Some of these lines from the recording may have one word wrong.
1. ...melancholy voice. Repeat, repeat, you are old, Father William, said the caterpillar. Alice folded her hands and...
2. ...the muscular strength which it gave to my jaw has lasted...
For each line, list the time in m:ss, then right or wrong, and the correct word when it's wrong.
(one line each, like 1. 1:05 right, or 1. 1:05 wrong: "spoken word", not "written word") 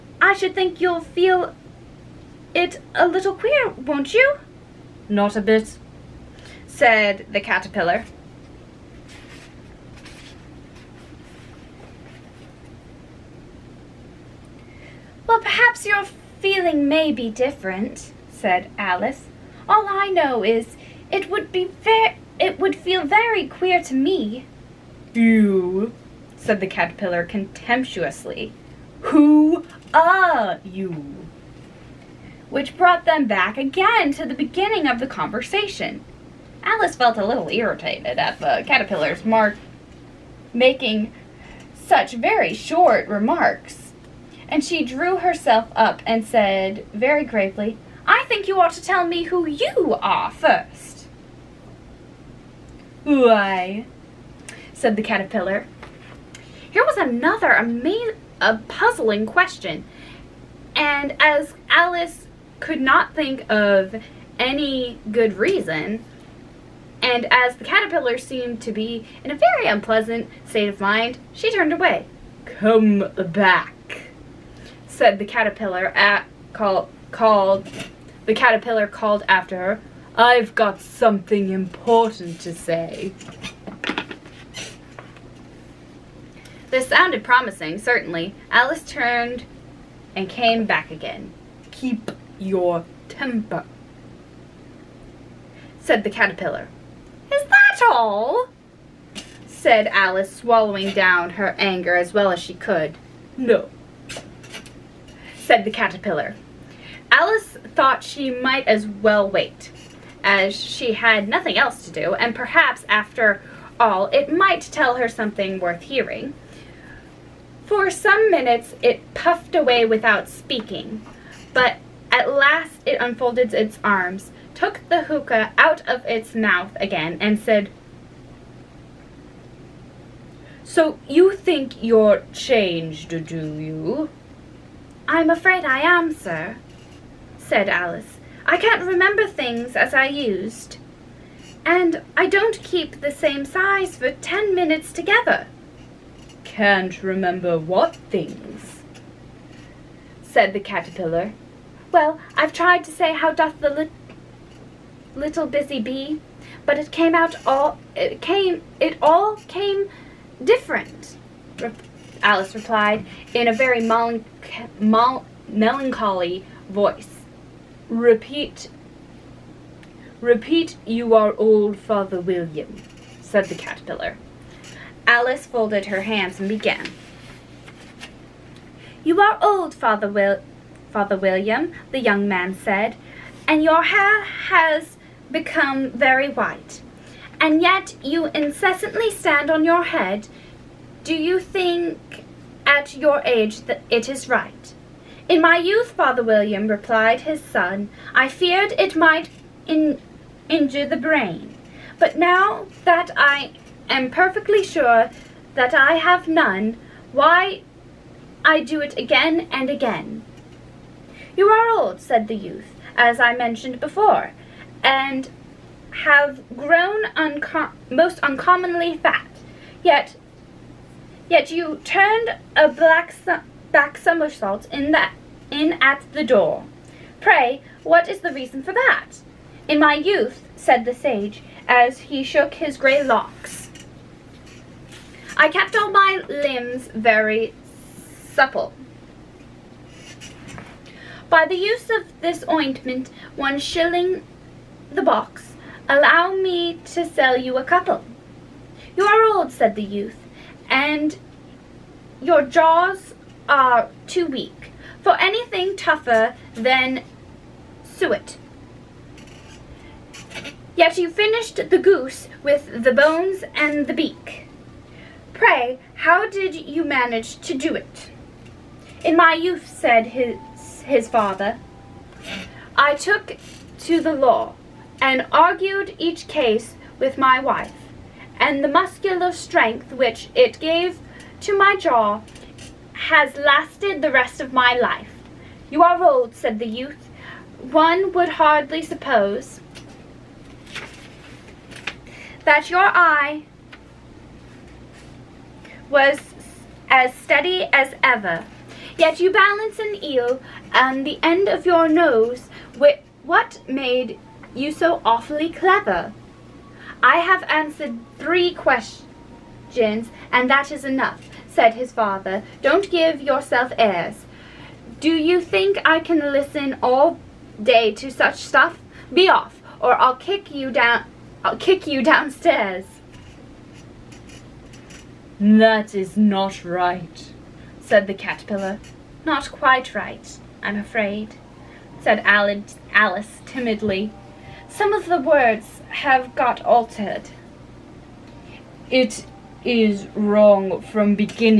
1. 2:44 right
2. 4:38 right.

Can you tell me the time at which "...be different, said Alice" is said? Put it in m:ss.
0:17.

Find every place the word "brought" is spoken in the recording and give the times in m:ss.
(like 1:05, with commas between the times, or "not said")
0:32.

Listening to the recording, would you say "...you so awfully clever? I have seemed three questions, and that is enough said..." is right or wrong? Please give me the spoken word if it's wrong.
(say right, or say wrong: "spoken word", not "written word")
wrong: "answered", not "seemed".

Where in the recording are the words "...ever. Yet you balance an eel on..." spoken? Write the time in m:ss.
4:58.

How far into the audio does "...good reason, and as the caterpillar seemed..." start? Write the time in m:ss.
1:05.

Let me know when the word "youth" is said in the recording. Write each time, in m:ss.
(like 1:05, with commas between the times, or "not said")
3:15, 3:32, 3:49, 4:09, 4:29, 4:46.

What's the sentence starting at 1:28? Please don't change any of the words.
Alice turned and came back again.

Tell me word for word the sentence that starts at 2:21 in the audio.
And I don't keep the same size for ten minutes together.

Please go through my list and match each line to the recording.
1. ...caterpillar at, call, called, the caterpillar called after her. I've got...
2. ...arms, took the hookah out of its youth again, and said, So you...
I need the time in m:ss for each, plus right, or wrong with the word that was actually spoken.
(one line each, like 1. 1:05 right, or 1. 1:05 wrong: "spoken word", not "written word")
1. 1:15 right
2. 2:03 wrong: "mouth", not "youth".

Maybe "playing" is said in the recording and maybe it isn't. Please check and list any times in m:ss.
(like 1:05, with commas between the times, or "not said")
not said.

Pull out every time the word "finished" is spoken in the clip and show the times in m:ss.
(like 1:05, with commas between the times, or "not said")
4:21.